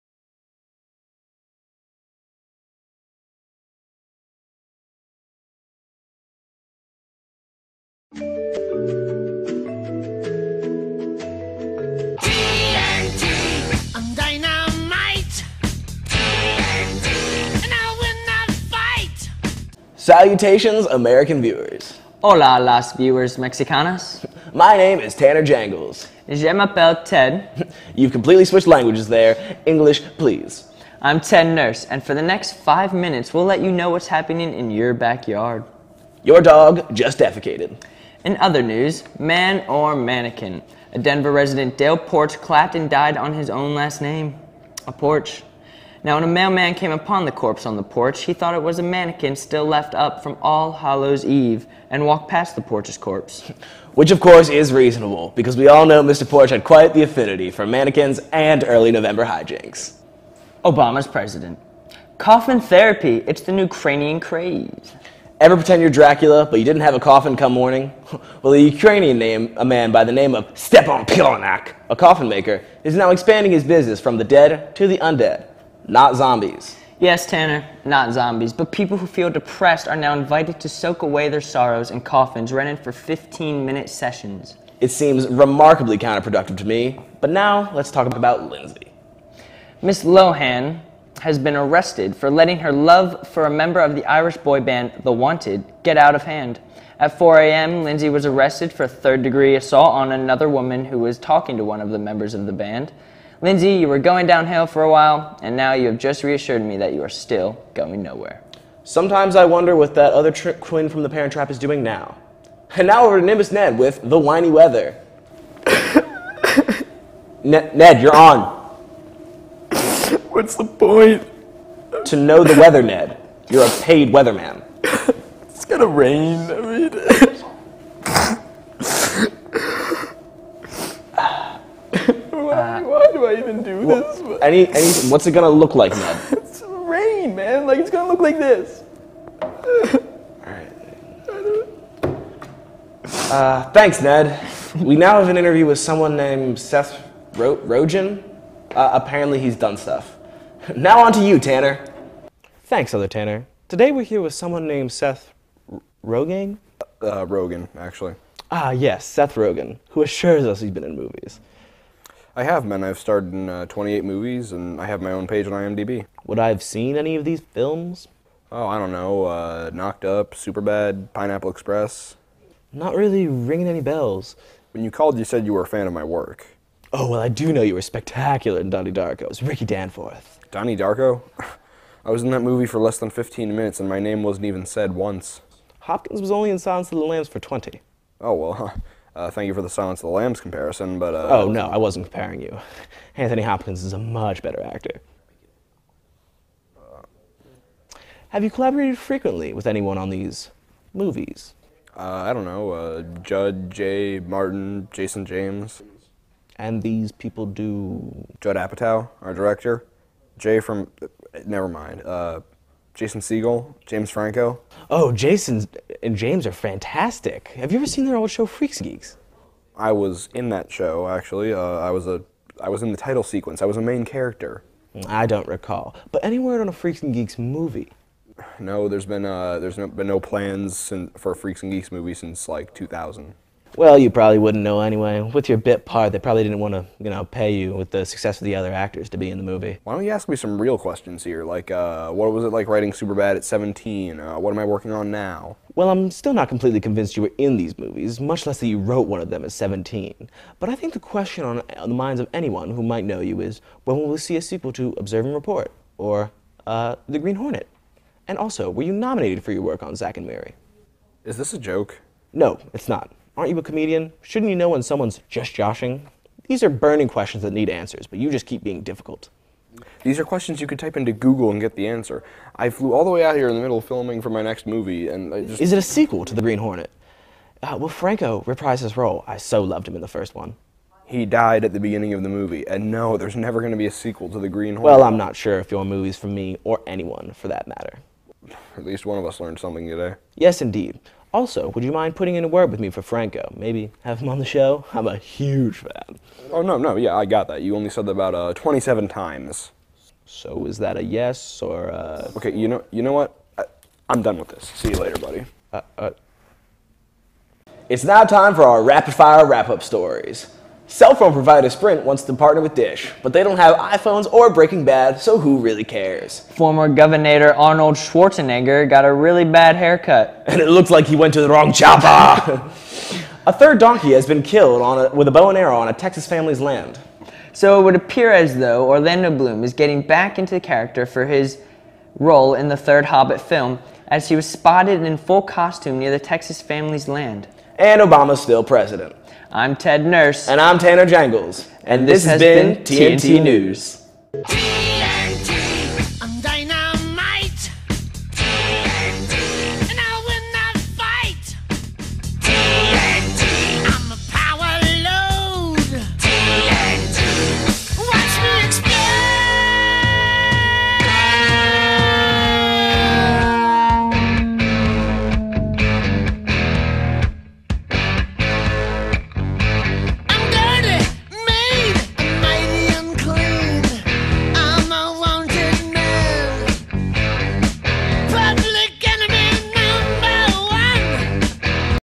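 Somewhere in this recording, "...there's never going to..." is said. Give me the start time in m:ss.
4:43.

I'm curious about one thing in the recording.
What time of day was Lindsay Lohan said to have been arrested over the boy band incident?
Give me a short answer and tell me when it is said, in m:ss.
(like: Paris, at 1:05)
4 a.m., at 1:37.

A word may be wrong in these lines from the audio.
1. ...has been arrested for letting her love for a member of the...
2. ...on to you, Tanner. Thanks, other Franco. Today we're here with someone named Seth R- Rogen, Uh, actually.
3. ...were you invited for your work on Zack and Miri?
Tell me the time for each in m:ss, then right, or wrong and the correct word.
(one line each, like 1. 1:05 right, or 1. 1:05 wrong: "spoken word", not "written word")
1. 1:31 right
2. 2:31 wrong: "Tanner", not "Franco"
3. 4:18 wrong: "nominated", not "invited".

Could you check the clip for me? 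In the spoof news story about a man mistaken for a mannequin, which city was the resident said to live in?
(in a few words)
Denver.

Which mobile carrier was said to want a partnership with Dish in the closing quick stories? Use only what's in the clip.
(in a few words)
Sprint.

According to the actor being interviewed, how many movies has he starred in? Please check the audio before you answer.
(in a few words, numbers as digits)
28.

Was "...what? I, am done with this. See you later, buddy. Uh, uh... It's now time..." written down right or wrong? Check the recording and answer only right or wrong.
right.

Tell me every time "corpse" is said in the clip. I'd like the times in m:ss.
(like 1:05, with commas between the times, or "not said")
0:47, 0:52.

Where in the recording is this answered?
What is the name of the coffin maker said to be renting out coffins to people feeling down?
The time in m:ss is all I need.
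1:10.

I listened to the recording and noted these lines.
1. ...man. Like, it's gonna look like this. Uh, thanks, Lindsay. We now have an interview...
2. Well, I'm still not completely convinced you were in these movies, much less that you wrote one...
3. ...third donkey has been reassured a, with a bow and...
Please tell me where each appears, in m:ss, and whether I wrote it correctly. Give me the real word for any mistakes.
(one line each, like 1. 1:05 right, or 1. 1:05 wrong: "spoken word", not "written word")
1. 2:17 wrong: "Ned", not "Lindsay"
2. 4:05 right
3. 5:23 wrong: "killed", not "reassured".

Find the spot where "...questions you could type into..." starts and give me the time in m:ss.
4:30.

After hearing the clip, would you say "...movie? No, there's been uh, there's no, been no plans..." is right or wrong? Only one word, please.
right.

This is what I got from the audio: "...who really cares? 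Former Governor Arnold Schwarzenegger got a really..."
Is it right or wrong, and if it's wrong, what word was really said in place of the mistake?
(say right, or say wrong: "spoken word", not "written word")
right.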